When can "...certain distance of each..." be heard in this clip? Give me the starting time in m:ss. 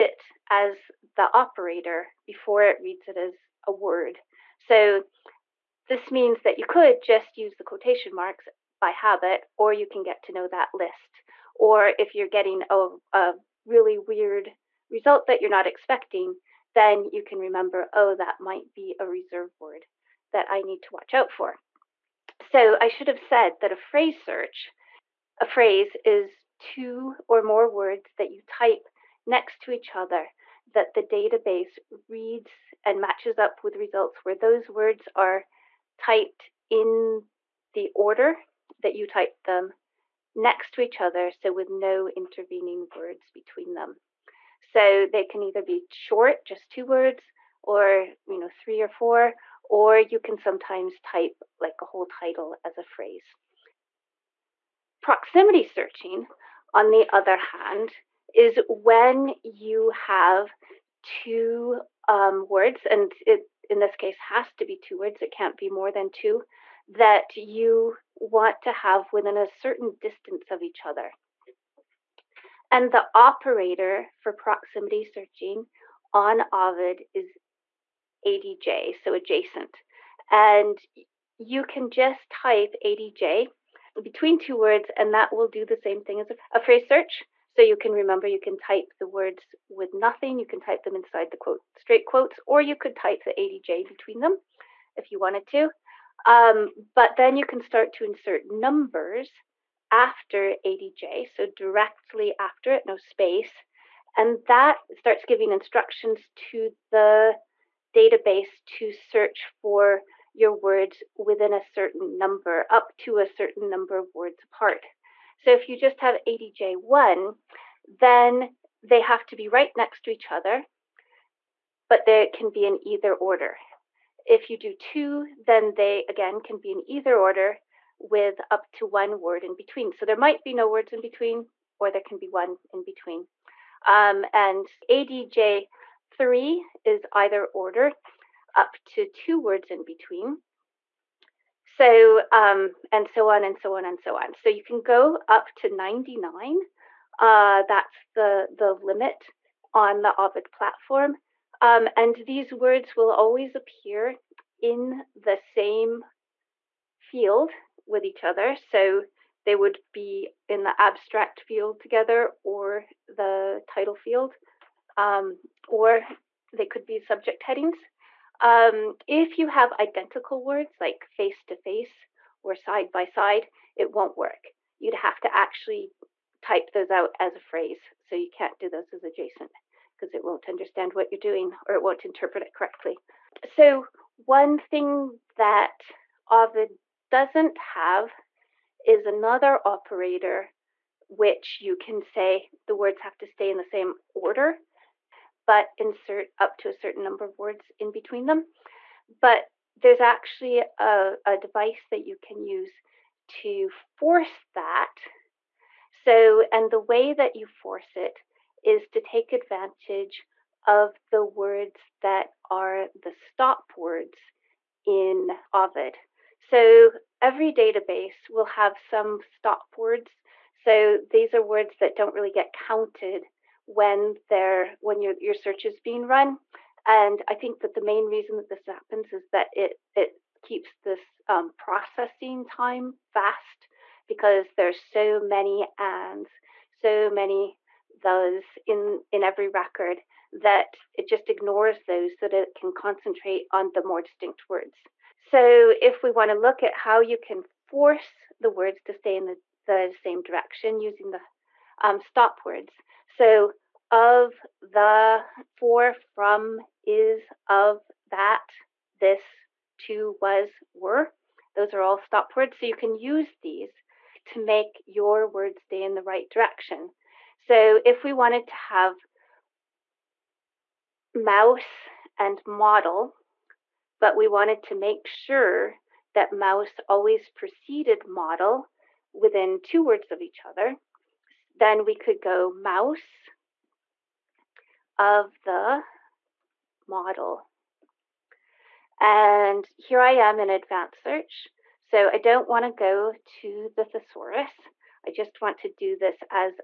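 1:09.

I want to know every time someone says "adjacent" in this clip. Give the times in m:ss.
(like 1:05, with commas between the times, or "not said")
1:19, 2:59.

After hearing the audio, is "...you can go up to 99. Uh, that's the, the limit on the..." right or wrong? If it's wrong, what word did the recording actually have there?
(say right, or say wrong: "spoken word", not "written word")
right.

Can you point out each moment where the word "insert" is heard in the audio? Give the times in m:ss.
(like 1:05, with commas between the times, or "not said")
1:38, 3:15.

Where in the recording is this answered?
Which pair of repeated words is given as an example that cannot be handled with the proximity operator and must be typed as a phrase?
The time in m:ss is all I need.
2:51.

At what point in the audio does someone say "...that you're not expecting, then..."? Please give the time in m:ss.
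0:15.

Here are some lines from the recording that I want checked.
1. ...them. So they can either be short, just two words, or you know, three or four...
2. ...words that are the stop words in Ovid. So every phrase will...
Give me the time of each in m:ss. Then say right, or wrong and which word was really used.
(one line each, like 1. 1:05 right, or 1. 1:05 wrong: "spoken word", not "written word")
1. 0:43 right
2. 3:31 wrong: "database", not "phrase".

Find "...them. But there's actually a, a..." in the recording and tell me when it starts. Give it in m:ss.
3:18.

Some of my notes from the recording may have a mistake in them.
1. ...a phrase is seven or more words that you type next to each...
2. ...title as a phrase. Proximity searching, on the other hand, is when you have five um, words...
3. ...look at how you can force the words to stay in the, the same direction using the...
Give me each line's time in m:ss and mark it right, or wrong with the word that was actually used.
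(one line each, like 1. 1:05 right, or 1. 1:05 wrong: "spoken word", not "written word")
1. 0:25 wrong: "two", not "seven"
2. 0:52 wrong: "two", not "five"
3. 4:06 right.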